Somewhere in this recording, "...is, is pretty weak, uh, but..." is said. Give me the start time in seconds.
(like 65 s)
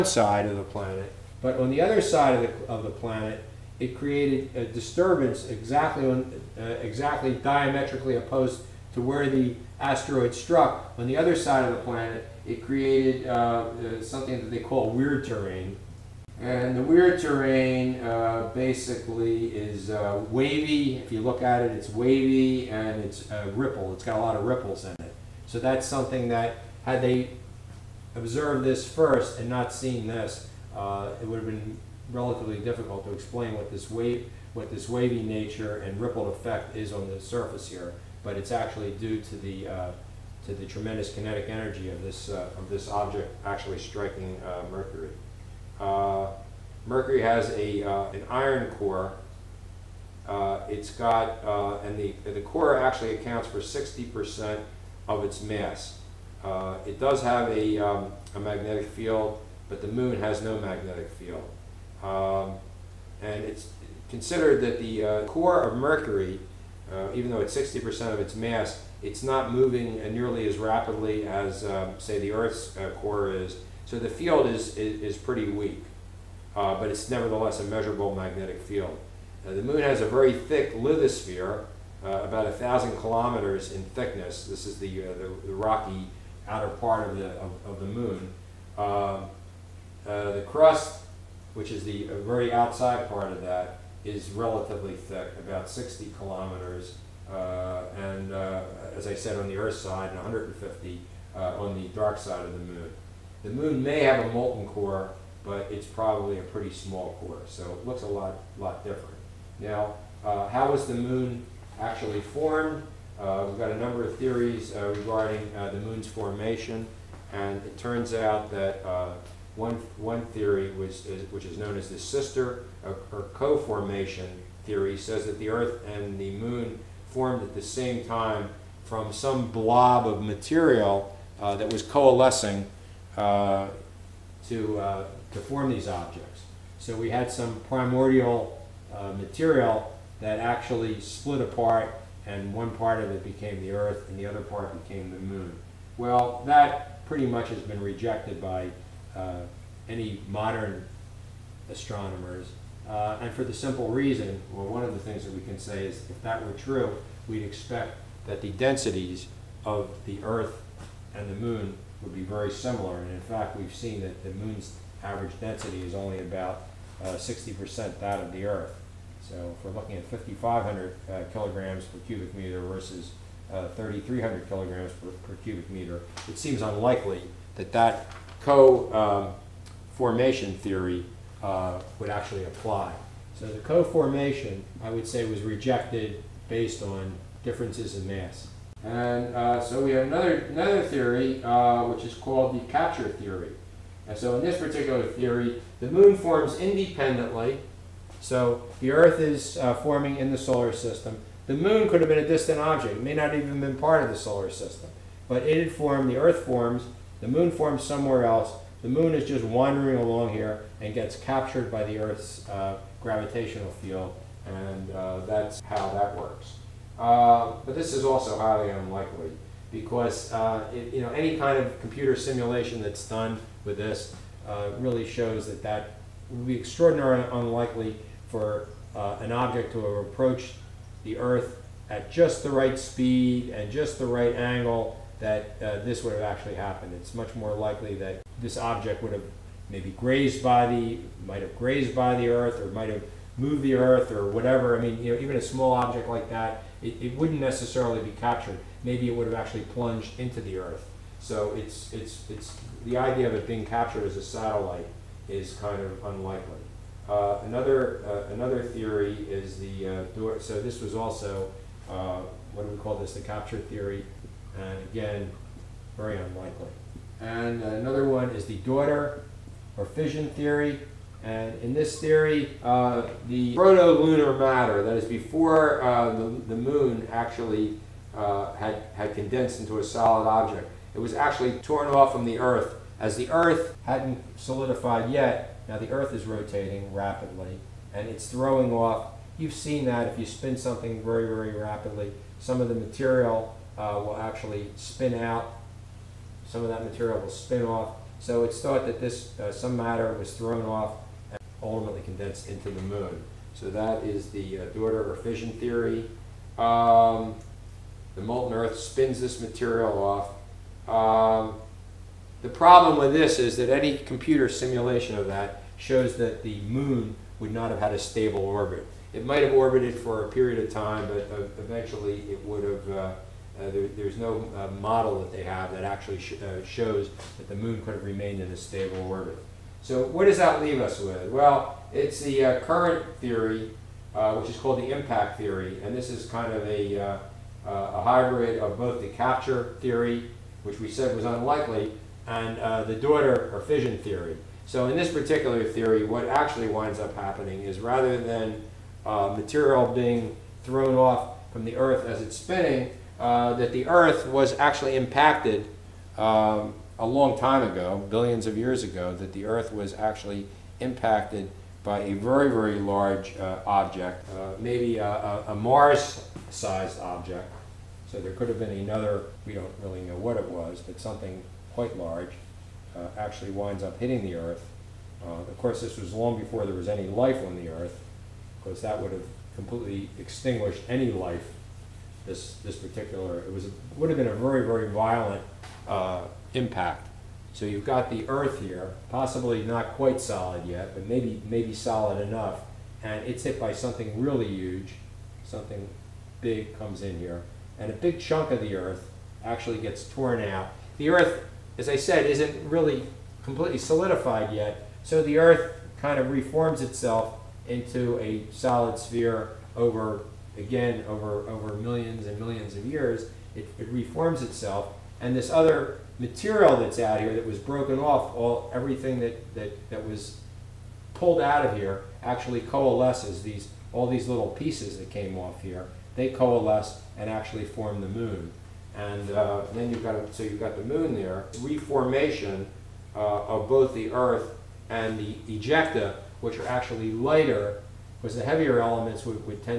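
74 s.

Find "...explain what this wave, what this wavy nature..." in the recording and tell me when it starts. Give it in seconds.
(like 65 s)
33 s.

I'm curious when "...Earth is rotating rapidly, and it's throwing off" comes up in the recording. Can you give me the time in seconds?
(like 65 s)
285 s.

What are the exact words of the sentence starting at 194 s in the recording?
And so in this particular theory, the moon forms independently so the Earth is uh, forming in the solar system.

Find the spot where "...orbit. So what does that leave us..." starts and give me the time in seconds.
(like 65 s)
329 s.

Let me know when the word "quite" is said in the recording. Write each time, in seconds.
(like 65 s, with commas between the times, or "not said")
371 s, 389 s.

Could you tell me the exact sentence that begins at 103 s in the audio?
The moon may have a molten core, but it's probably a pretty small core, so it looks a lot, lot different.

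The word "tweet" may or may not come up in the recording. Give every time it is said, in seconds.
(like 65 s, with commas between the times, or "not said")
not said.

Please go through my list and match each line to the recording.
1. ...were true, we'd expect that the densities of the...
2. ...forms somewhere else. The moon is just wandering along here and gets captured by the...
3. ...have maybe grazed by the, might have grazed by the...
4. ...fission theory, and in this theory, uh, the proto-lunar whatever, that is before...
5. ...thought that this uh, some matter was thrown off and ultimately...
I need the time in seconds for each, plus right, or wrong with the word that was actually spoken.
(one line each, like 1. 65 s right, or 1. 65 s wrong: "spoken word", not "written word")
1. 156 s right
2. 207 s right
3. 239 s right
4. 269 s wrong: "matter", not "whatever"
5. 298 s right.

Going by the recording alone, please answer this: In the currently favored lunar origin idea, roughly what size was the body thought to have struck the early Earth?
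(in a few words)
Mars-sized.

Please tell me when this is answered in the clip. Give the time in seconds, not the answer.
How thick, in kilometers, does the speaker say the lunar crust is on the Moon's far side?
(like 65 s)
100 s.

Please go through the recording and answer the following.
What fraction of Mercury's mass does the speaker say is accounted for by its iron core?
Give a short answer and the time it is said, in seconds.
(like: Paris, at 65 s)
60 percent, at 53 s.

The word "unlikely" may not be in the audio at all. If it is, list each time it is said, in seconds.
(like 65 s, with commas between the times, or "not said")
176 s, 218 s, 227 s, 256 s, 266 s, 341 s.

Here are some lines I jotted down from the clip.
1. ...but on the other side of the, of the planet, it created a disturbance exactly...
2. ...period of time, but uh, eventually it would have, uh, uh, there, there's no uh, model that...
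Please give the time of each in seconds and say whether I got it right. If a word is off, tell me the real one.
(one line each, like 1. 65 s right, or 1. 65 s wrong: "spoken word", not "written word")
1. 1 s right
2. 320 s right.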